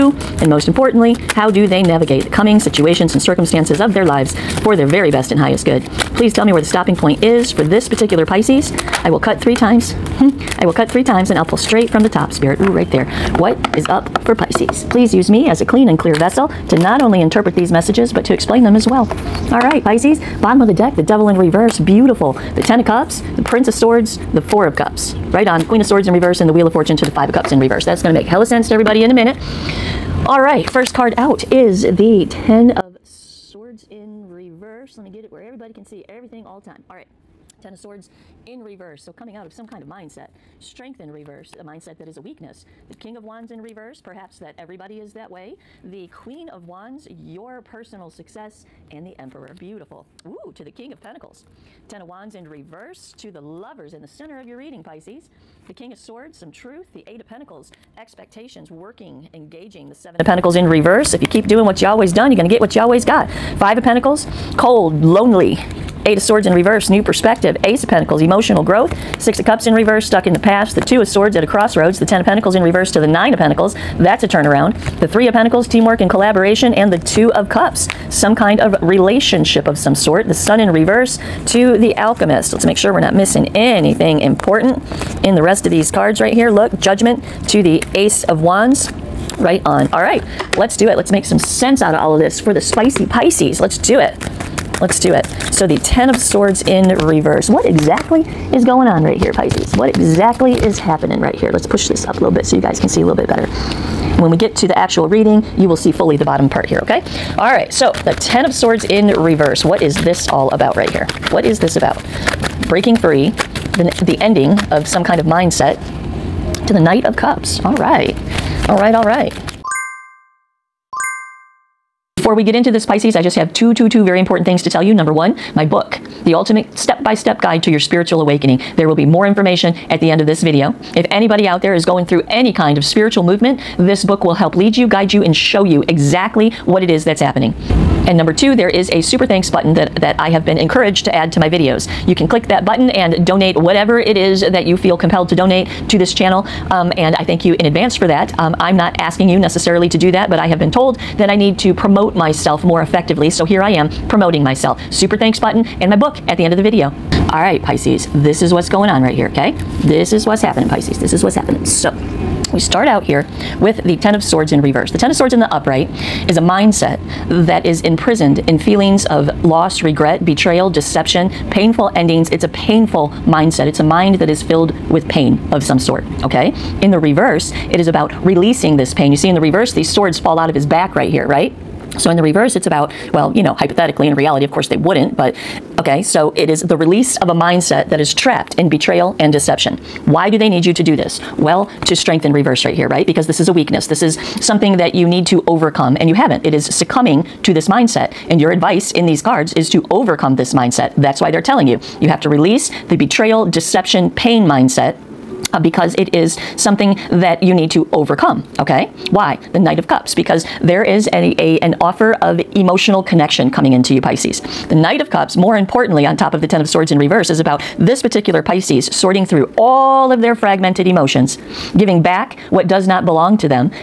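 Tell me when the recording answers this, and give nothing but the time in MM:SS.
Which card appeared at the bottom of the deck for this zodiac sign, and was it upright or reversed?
00:20.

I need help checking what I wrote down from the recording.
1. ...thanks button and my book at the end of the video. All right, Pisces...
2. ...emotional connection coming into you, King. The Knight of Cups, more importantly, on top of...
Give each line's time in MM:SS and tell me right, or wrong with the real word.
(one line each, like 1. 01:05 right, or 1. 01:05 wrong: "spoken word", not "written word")
1. 02:35 right
2. 03:32 wrong: "Pisces", not "King".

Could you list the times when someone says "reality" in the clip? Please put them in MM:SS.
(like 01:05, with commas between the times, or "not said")
03:04.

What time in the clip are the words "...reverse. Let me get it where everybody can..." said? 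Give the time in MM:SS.
00:34.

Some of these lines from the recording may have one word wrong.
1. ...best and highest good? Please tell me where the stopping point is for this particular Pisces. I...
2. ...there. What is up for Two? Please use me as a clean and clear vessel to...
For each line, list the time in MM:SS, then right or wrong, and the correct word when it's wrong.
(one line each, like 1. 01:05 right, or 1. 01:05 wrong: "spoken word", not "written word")
1. 00:05 right
2. 00:12 wrong: "Pisces", not "Two".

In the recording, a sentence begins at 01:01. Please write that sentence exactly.
If you keep doing what you always done, you're going to get what you always got.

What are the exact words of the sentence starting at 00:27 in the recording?
That's going to make hella sense to everybody in a minute.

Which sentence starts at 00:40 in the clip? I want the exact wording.
Strength in reverse, a mindset that is a weakness.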